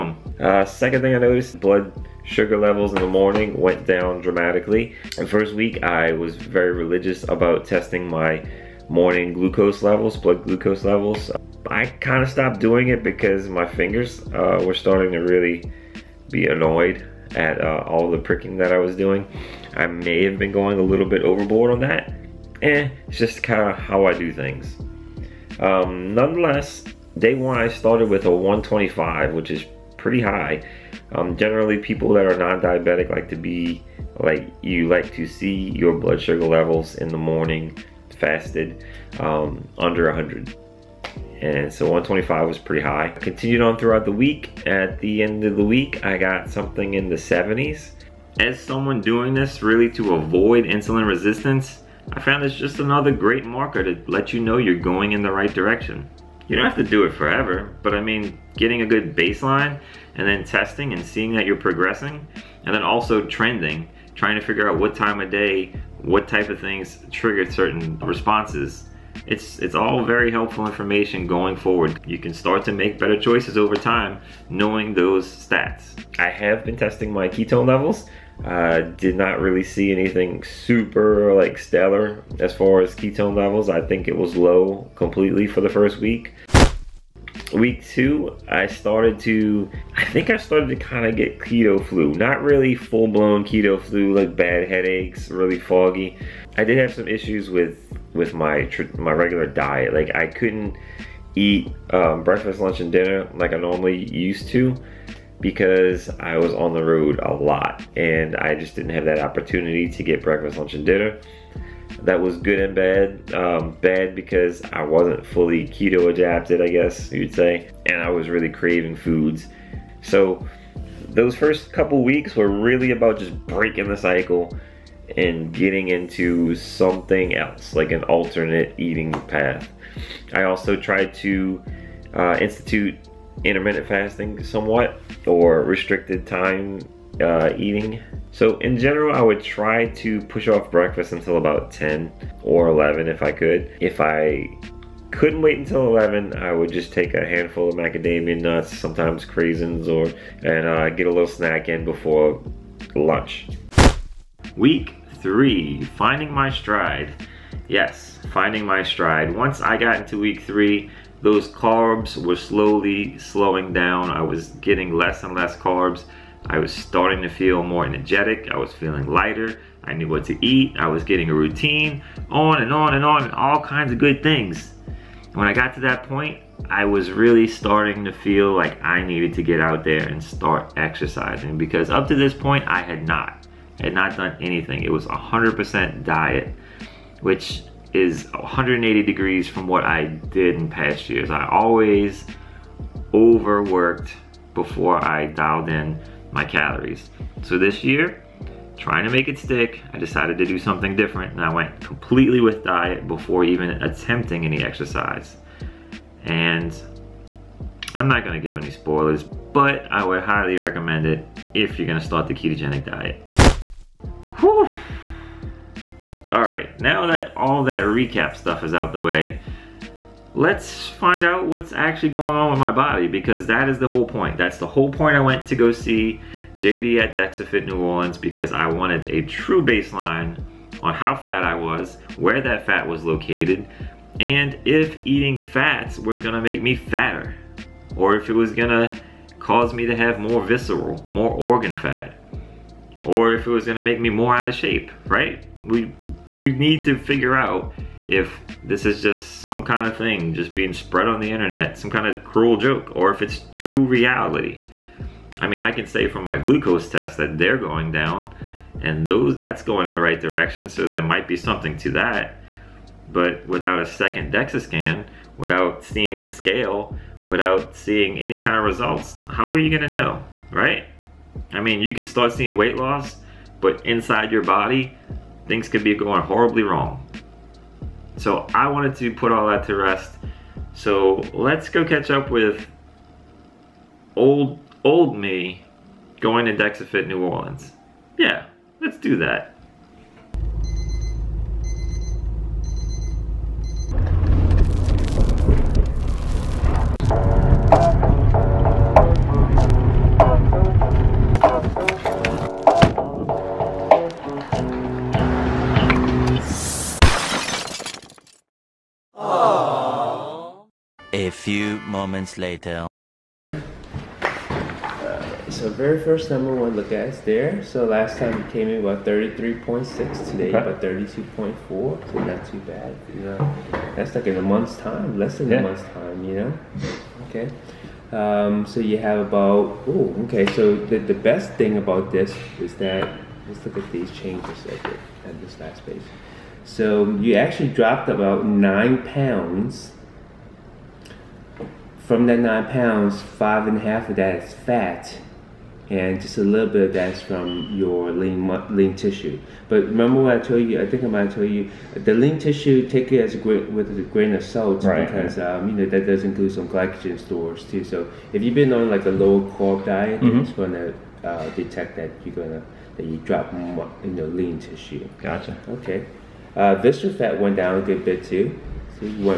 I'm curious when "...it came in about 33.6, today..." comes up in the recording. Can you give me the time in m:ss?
5:18.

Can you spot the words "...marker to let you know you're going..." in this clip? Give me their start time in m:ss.
0:53.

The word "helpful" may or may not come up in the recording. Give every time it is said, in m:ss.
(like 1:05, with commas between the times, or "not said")
1:10.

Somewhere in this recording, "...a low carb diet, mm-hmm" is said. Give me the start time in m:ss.
5:59.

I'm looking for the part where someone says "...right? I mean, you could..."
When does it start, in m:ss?
4:30.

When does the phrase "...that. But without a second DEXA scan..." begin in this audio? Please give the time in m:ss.
4:21.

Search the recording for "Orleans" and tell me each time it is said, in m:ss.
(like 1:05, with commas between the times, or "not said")
3:47, 4:47.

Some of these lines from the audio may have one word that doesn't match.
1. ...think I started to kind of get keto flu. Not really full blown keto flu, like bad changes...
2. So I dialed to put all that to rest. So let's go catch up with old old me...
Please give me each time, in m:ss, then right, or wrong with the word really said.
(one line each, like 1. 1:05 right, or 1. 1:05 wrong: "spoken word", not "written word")
1. 1:30 wrong: "headaches", not "changes"
2. 4:38 wrong: "wanted", not "dialed".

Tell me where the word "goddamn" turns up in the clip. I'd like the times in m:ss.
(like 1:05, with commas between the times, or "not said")
not said.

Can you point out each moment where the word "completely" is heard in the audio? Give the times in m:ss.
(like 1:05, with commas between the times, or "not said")
1:24, 3:21.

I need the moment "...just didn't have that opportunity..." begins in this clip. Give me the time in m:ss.
1:48.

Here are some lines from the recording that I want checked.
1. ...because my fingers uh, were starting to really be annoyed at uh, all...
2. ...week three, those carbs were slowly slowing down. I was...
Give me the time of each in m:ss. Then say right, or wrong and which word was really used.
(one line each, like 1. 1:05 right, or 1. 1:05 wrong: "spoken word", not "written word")
1. 0:13 right
2. 2:40 right.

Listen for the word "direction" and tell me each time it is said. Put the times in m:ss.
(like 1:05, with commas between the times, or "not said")
0:55, 4:20.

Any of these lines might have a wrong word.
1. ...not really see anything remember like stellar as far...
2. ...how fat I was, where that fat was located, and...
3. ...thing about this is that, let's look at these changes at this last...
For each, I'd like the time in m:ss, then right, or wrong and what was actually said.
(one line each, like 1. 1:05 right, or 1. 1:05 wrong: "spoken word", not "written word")
1. 1:19 wrong: "super", not "remember"
2. 3:50 right
3. 5:31 right.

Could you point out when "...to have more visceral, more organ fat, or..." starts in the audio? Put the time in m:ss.
3:59.